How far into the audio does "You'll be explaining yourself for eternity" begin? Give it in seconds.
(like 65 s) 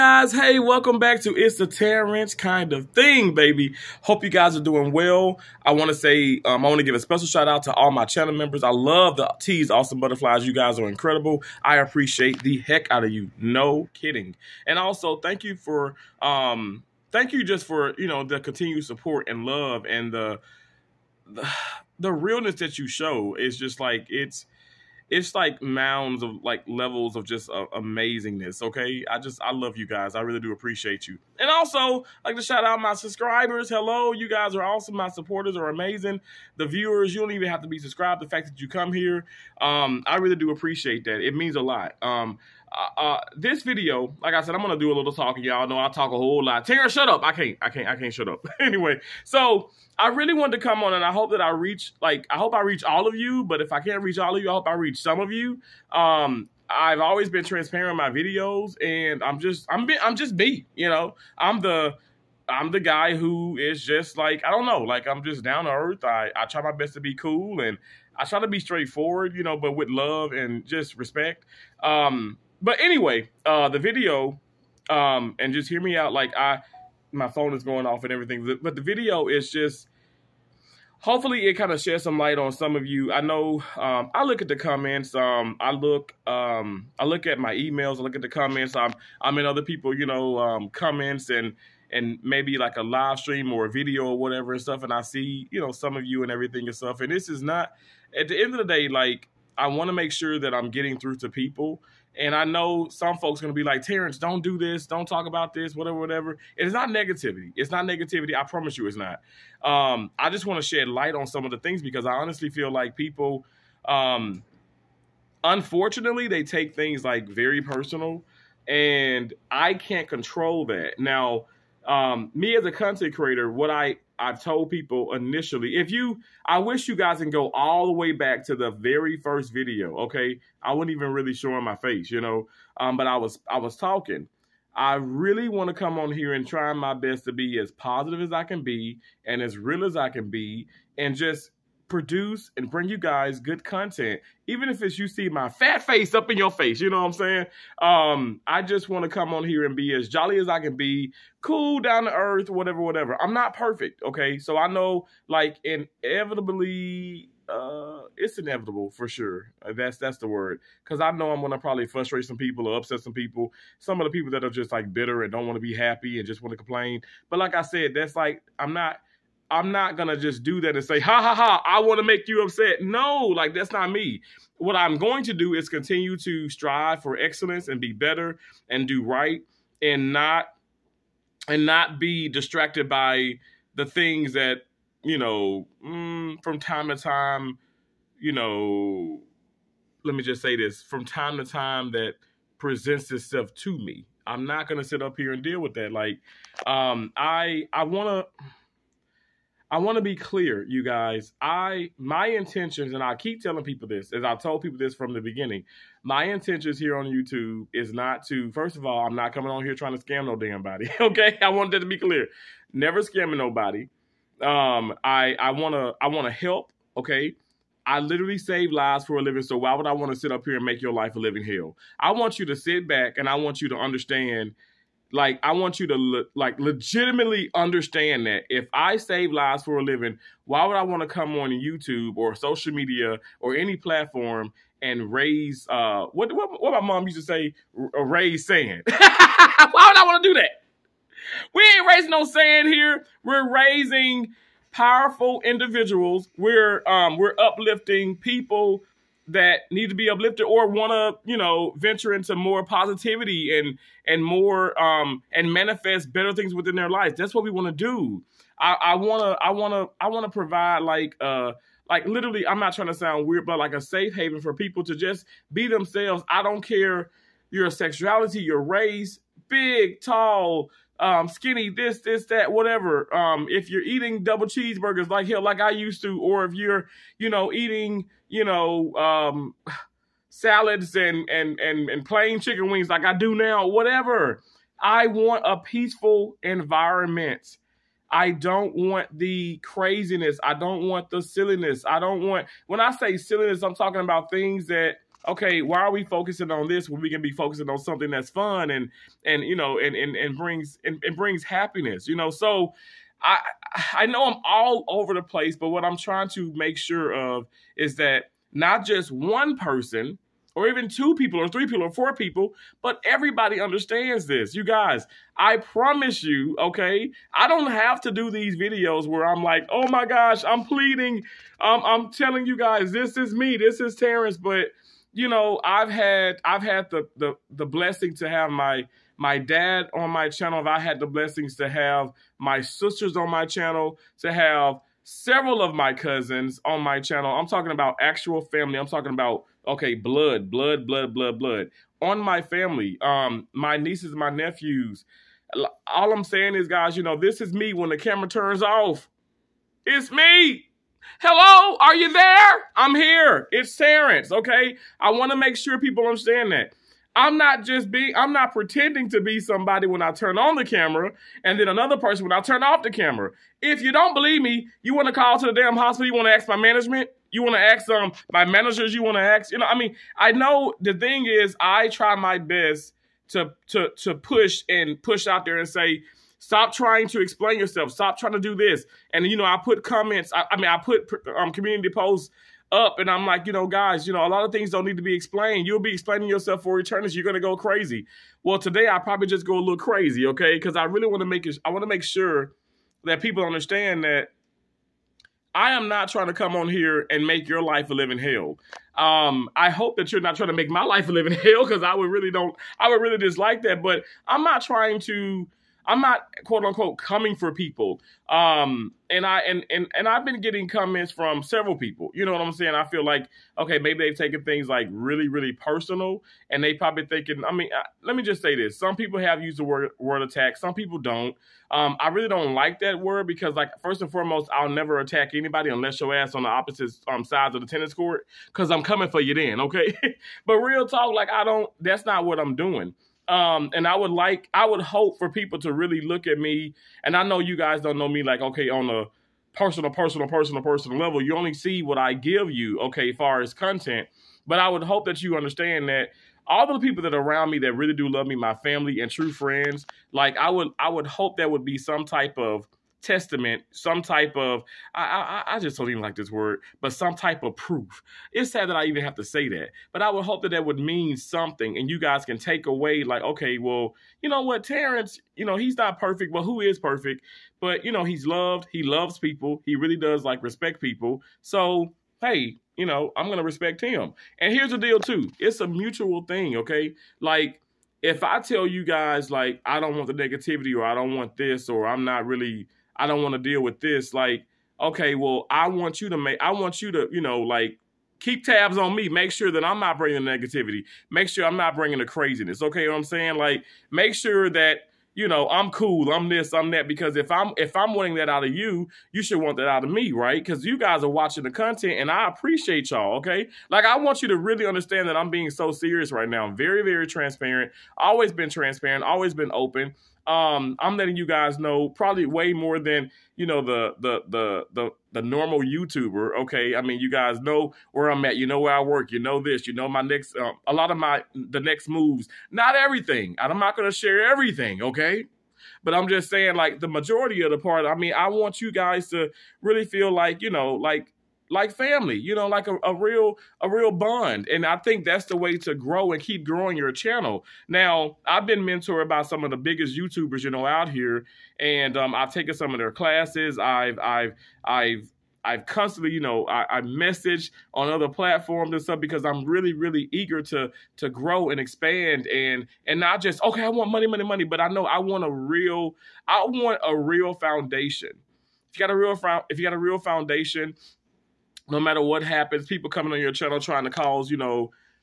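385 s.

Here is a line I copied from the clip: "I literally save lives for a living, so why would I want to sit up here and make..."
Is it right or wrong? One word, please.
right.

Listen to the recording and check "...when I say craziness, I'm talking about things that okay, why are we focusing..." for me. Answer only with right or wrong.
wrong.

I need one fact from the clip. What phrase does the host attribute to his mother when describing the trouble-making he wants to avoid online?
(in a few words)
raise sand.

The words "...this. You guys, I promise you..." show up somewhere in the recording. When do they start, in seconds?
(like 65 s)
314 s.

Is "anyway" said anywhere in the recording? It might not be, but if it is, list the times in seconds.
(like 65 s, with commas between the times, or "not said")
48 s, 72 s.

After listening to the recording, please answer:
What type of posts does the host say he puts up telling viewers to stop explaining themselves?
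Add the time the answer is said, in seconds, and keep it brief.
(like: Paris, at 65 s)
community posts, at 381 s.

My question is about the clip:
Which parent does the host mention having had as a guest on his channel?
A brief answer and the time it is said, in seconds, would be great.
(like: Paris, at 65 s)
dad, at 329 s.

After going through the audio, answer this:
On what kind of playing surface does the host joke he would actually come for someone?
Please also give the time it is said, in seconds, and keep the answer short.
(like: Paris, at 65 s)
tennis court, at 427 s.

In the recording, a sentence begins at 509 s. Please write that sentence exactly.
Always been open um, I'm letting you guys know probably way more than you know the the the the the normal YouTuber.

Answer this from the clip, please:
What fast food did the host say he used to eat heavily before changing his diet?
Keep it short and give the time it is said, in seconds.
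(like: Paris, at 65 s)
double cheeseburgers, at 274 s.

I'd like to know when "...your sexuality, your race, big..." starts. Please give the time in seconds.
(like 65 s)
267 s.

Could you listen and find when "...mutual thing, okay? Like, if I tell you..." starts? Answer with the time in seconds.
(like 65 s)
475 s.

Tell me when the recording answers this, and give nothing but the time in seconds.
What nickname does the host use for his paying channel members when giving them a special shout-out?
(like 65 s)
9 s.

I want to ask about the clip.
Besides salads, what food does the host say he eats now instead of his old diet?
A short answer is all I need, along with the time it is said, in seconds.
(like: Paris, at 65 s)
plain chicken wings, at 282 s.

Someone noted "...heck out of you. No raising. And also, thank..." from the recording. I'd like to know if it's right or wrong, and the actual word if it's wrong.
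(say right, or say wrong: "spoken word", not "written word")
wrong: "kidding", not "raising".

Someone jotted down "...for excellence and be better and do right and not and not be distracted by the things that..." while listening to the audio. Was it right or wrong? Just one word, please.
right.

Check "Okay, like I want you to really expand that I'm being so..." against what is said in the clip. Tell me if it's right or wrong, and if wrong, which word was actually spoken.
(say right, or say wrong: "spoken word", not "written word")
wrong: "understand", not "expand".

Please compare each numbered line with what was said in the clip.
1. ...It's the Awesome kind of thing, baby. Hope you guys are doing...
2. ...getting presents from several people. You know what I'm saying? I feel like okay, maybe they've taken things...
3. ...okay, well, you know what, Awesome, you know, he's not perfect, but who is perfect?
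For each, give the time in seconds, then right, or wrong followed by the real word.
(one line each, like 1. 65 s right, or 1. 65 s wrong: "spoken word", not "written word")
1. 1 s wrong: "Terrance", not "Awesome"
2. 410 s wrong: "comments", not "presents"
3. 463 s wrong: "Terrance", not "Awesome".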